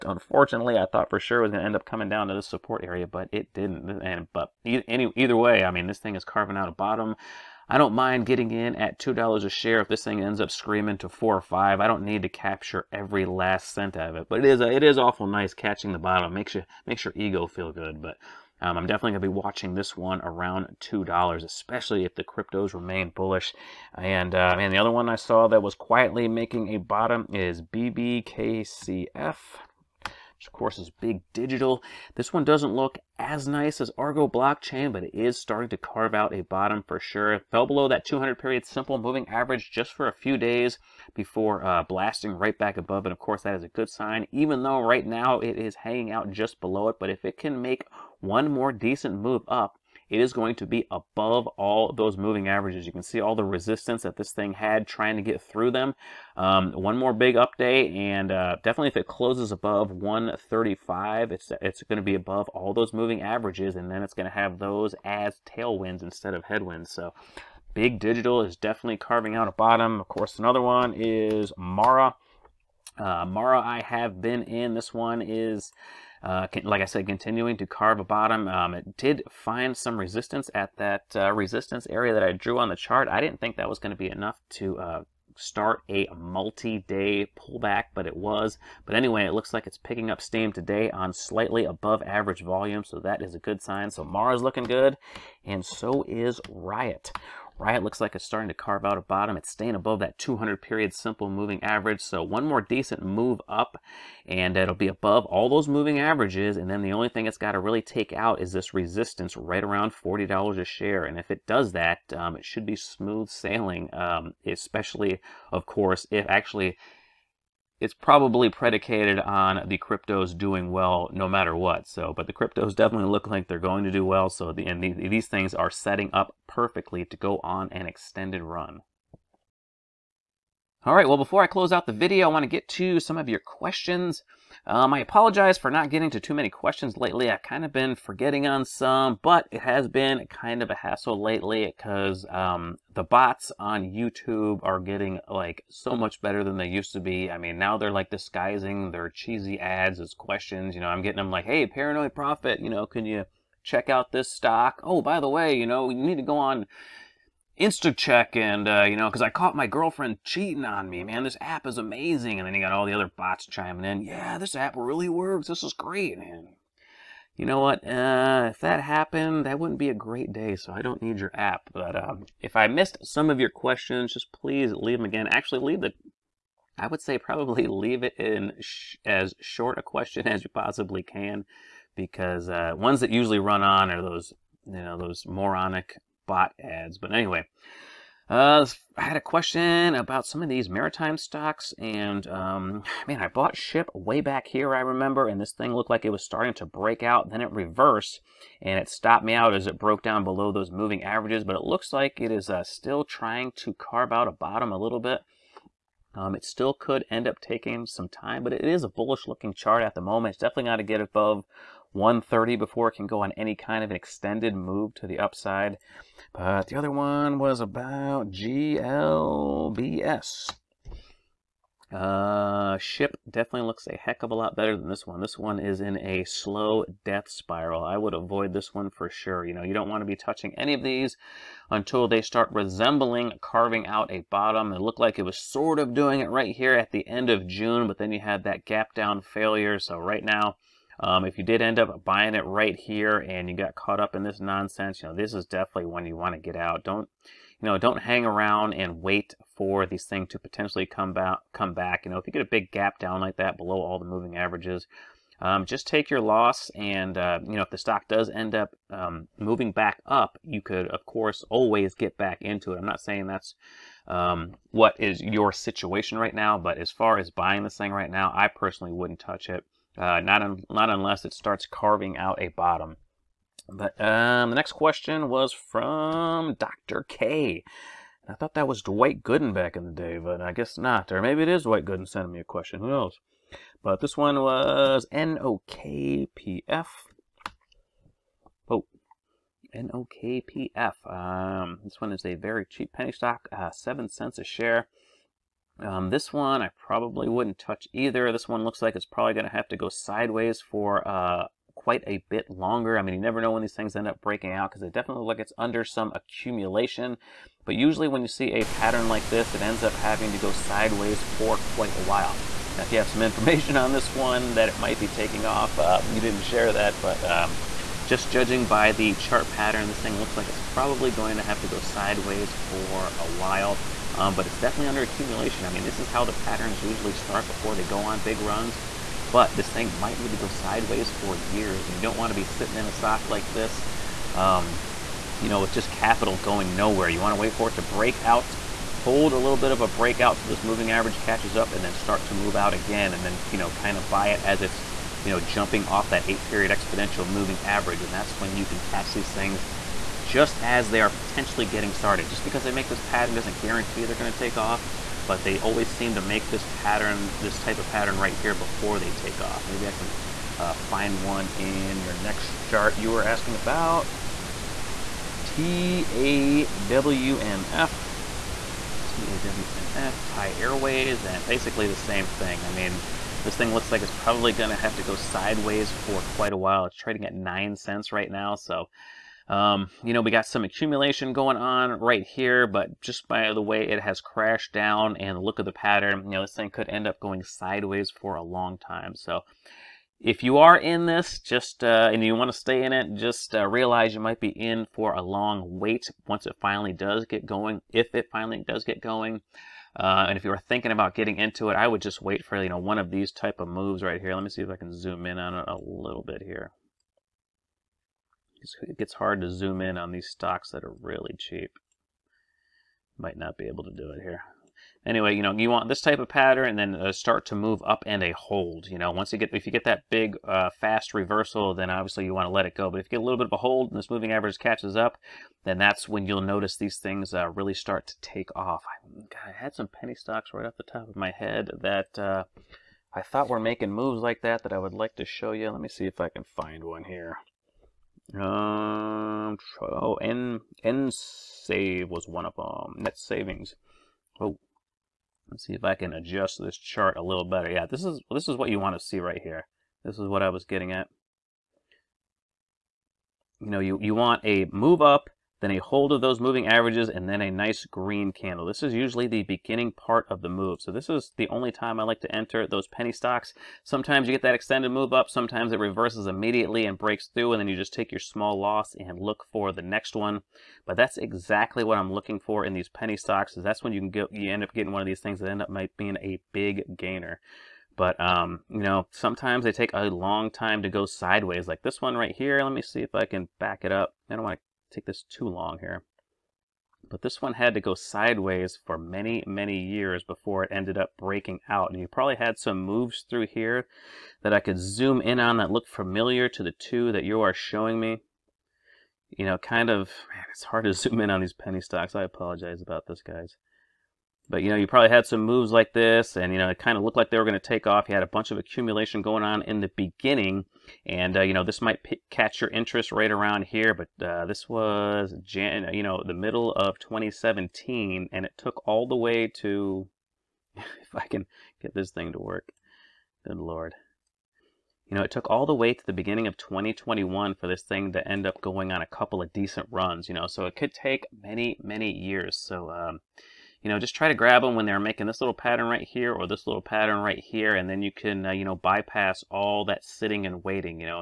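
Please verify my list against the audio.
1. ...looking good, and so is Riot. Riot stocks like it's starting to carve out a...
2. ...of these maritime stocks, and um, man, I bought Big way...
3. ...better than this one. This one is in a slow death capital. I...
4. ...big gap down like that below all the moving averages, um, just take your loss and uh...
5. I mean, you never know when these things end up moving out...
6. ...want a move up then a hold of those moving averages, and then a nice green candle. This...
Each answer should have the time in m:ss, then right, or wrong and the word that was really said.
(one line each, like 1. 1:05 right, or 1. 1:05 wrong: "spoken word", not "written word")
1. 1:34 wrong: "looks", not "stocks"
2. 3:10 wrong: "Ship", not "Big"
3. 3:44 wrong: "spiral", not "capital"
4. 4:12 right
5. 5:02 wrong: "breaking", not "moving"
6. 7:34 right.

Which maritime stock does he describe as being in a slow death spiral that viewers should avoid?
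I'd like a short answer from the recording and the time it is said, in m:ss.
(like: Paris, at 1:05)
GLBS, at 3:38.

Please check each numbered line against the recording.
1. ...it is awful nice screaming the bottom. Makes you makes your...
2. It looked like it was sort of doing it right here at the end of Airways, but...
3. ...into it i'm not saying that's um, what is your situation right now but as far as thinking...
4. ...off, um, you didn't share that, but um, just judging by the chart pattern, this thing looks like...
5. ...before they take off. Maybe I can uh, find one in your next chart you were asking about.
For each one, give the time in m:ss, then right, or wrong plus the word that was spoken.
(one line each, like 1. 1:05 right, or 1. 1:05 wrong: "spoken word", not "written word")
1. 0:14 wrong: "catching", not "screaming"
2. 3:54 wrong: "June", not "Airways"
3. 4:22 wrong: "buying", not "thinking"
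4. 5:15 right
5. 5:58 right.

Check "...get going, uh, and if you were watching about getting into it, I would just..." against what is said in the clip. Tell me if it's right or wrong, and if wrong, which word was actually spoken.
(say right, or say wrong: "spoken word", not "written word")
wrong: "thinking", not "watching".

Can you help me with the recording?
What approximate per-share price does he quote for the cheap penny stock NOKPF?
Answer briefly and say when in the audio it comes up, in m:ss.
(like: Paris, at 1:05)
7 cents, at 4:53.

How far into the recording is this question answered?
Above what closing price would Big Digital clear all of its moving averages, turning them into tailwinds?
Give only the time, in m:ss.
0:59.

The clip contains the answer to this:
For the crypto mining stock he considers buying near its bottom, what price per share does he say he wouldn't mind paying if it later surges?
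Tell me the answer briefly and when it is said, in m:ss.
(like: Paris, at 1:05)
$2, at 0:08.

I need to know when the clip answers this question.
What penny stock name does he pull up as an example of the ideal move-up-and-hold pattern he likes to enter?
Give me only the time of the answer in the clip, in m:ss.
7:23.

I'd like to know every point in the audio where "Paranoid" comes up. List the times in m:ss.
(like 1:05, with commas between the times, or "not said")
2:31.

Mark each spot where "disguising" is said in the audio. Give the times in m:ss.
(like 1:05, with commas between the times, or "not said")
2:28.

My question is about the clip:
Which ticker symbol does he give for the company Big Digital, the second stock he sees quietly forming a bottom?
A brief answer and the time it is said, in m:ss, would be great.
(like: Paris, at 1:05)
BBKCF, at 0:27.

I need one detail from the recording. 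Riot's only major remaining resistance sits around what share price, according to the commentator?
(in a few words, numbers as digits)
$40.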